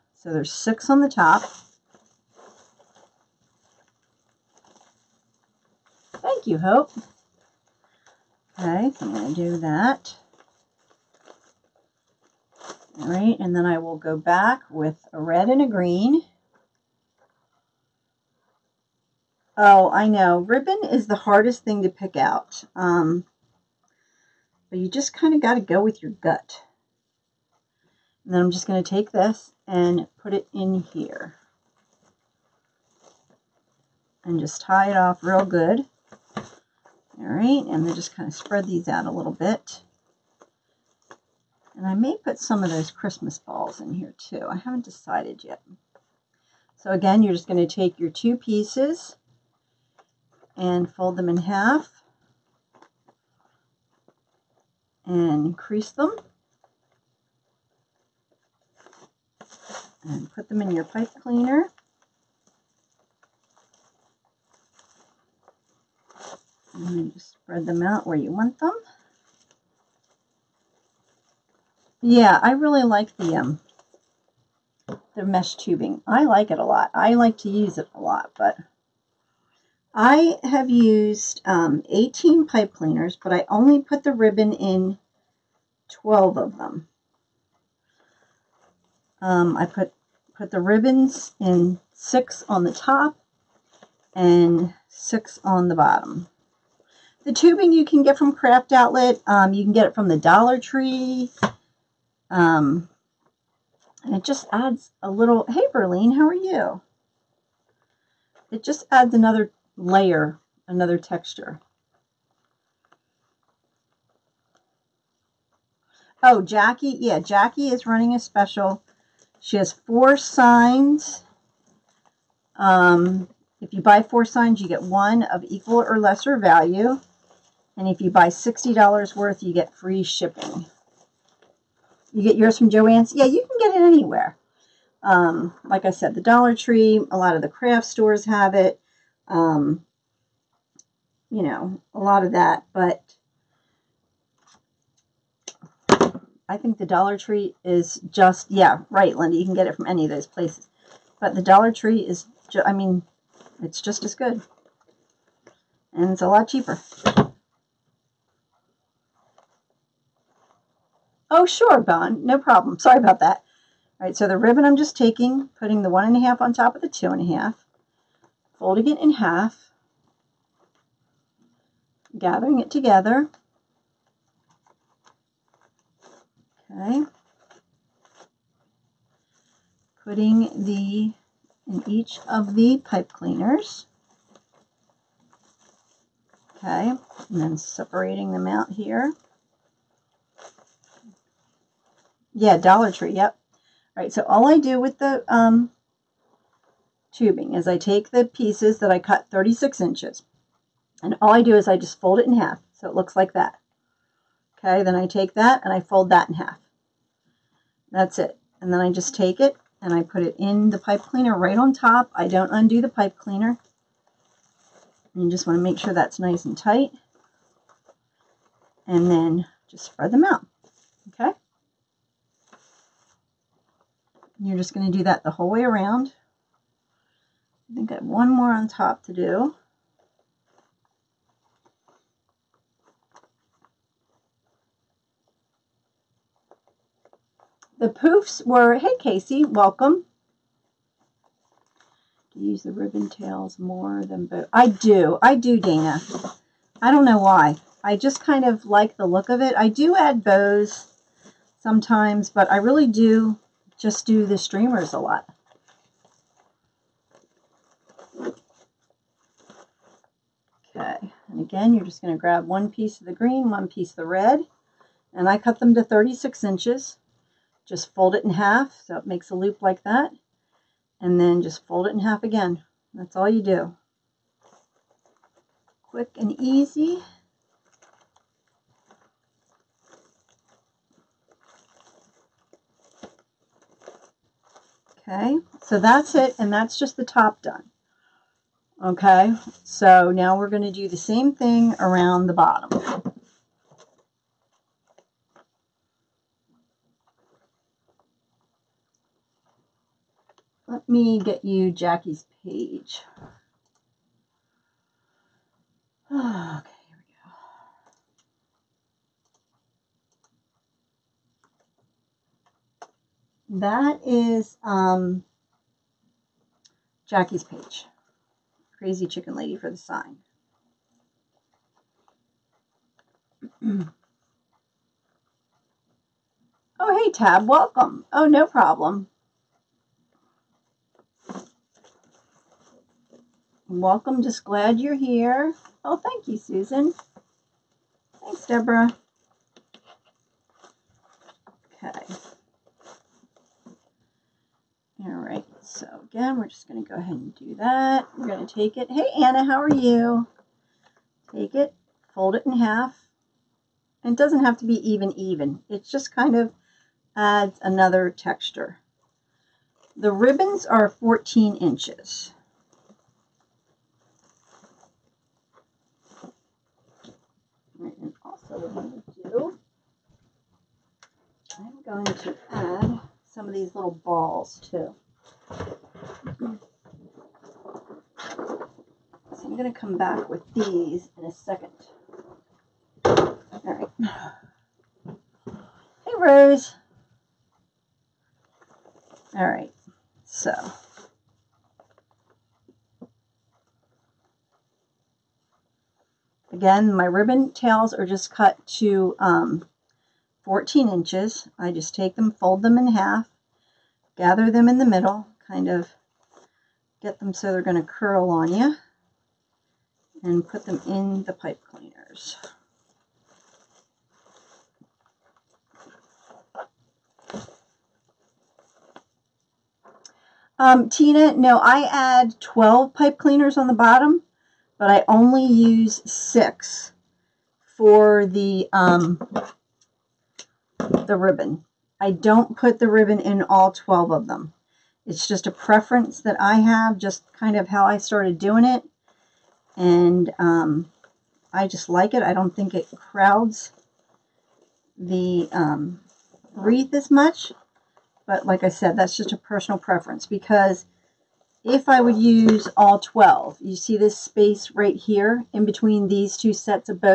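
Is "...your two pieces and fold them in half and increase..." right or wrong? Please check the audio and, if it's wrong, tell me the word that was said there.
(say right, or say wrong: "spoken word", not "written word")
right.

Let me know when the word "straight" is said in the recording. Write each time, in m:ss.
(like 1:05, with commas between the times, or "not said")
not said.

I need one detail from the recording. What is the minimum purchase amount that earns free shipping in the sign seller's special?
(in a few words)
$60.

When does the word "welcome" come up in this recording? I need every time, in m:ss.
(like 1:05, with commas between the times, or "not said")
3:59, 5:27, 5:33.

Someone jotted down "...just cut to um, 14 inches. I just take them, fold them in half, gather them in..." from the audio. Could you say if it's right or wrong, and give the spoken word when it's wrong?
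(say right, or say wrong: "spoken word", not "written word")
right.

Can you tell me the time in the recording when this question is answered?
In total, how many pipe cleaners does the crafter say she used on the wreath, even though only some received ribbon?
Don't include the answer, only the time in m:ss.
1:21.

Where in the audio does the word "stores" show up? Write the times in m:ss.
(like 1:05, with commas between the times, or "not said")
2:17.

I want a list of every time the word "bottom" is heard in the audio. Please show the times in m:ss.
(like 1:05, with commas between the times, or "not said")
1:35, 4:52, 7:03.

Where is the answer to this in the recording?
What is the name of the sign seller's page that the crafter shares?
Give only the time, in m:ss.
5:18.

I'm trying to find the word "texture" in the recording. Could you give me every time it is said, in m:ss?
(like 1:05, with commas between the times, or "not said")
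1:50, 5:58.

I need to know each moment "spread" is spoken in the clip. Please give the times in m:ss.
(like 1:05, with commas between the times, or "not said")
0:38, 1:07, 3:39.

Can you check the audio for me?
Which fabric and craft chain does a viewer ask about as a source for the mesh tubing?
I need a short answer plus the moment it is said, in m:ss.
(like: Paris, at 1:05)
Joann's, at 2:12.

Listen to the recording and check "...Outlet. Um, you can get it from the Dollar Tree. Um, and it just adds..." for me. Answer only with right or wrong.
right.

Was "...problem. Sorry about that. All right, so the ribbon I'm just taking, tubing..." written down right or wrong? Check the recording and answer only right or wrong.
wrong.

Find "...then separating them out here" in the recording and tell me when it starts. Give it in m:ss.
3:07.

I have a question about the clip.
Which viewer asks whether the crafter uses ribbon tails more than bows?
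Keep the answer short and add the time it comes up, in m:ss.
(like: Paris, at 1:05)
Dana, at 4:05.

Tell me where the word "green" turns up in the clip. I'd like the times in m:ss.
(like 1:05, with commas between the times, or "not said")
0:15, 4:23.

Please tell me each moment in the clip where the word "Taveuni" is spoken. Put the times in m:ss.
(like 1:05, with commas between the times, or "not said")
not said.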